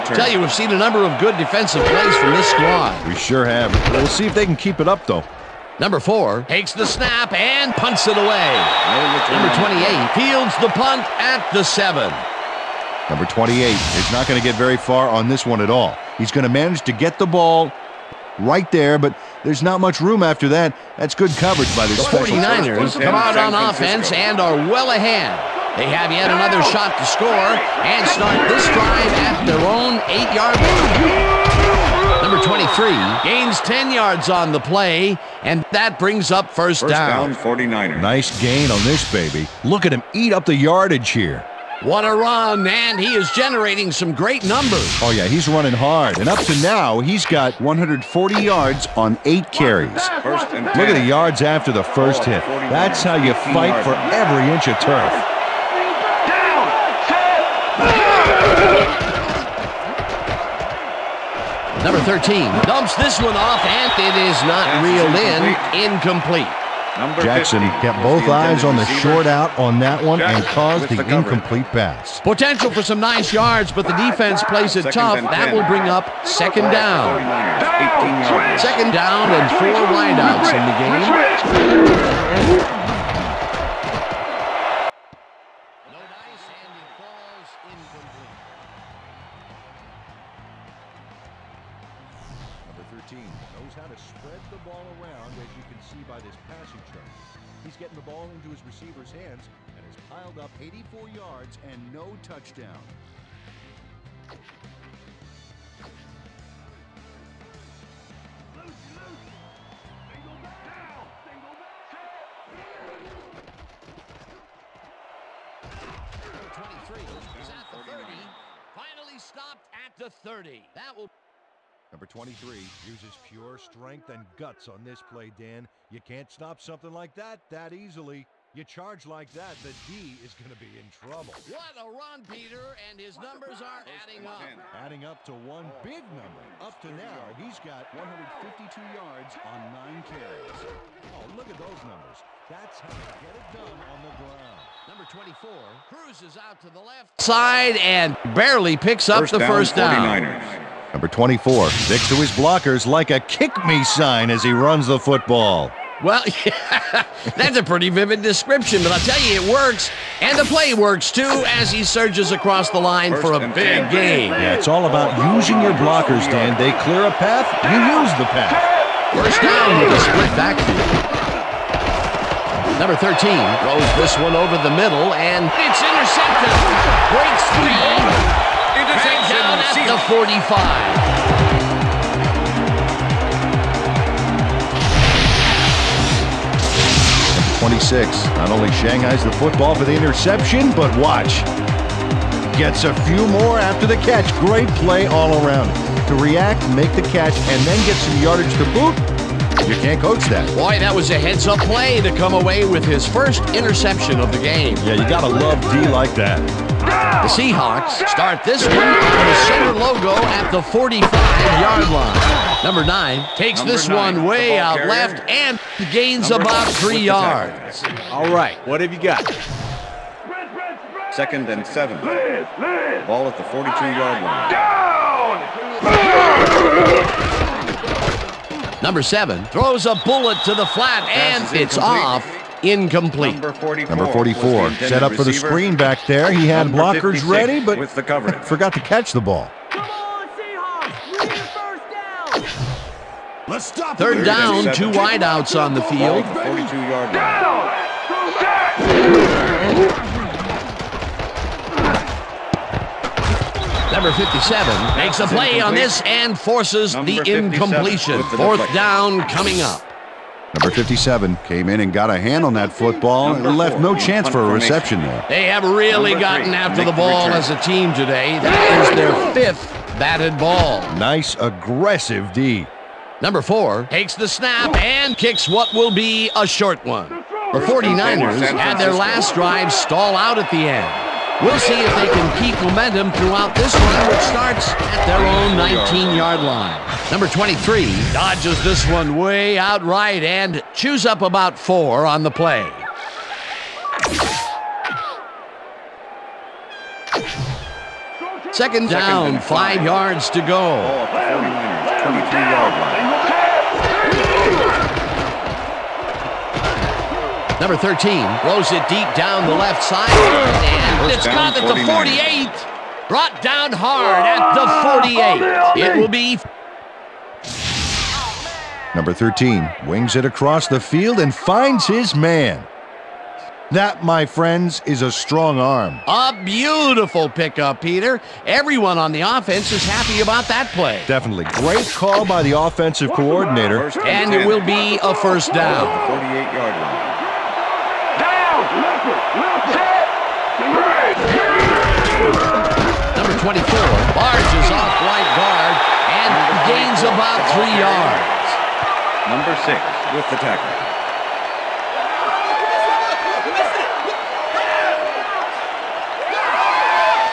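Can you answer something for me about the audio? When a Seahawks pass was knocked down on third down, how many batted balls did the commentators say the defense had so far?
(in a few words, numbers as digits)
5.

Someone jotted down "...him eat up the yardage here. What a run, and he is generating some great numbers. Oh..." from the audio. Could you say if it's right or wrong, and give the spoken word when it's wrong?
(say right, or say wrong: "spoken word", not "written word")
right.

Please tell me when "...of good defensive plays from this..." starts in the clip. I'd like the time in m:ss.
0:01.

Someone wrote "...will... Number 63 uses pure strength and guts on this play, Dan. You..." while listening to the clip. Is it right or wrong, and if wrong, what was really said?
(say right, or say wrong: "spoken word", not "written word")
wrong: "23", not "63".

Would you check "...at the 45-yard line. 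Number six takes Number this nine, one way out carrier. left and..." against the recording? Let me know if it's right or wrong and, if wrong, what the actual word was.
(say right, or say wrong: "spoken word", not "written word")
wrong: "nine", not "six".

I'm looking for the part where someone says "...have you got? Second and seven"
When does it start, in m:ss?
3:38.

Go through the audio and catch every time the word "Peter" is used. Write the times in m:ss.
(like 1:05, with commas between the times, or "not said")
2:12, 5:27.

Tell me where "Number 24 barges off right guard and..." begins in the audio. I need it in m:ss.
5:43.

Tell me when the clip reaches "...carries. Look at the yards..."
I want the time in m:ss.
0:49.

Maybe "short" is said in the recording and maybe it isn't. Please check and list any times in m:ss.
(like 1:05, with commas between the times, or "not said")
1:08, 4:36.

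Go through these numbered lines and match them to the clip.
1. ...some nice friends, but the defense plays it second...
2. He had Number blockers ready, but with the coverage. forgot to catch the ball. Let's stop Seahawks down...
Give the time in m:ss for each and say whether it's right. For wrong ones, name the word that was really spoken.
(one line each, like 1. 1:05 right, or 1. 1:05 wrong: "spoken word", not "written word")
1. 1:12 wrong: "yards", not "friends"
2. 3:56 wrong: "Third", not "Seahawks".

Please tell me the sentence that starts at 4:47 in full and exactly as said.
Number 23 dodges this one way outright and chews up about four on the play.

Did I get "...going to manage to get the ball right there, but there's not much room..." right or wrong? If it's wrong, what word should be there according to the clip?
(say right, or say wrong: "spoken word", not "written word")
right.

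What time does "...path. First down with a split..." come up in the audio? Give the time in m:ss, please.
2:48.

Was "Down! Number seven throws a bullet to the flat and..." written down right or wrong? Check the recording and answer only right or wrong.
right.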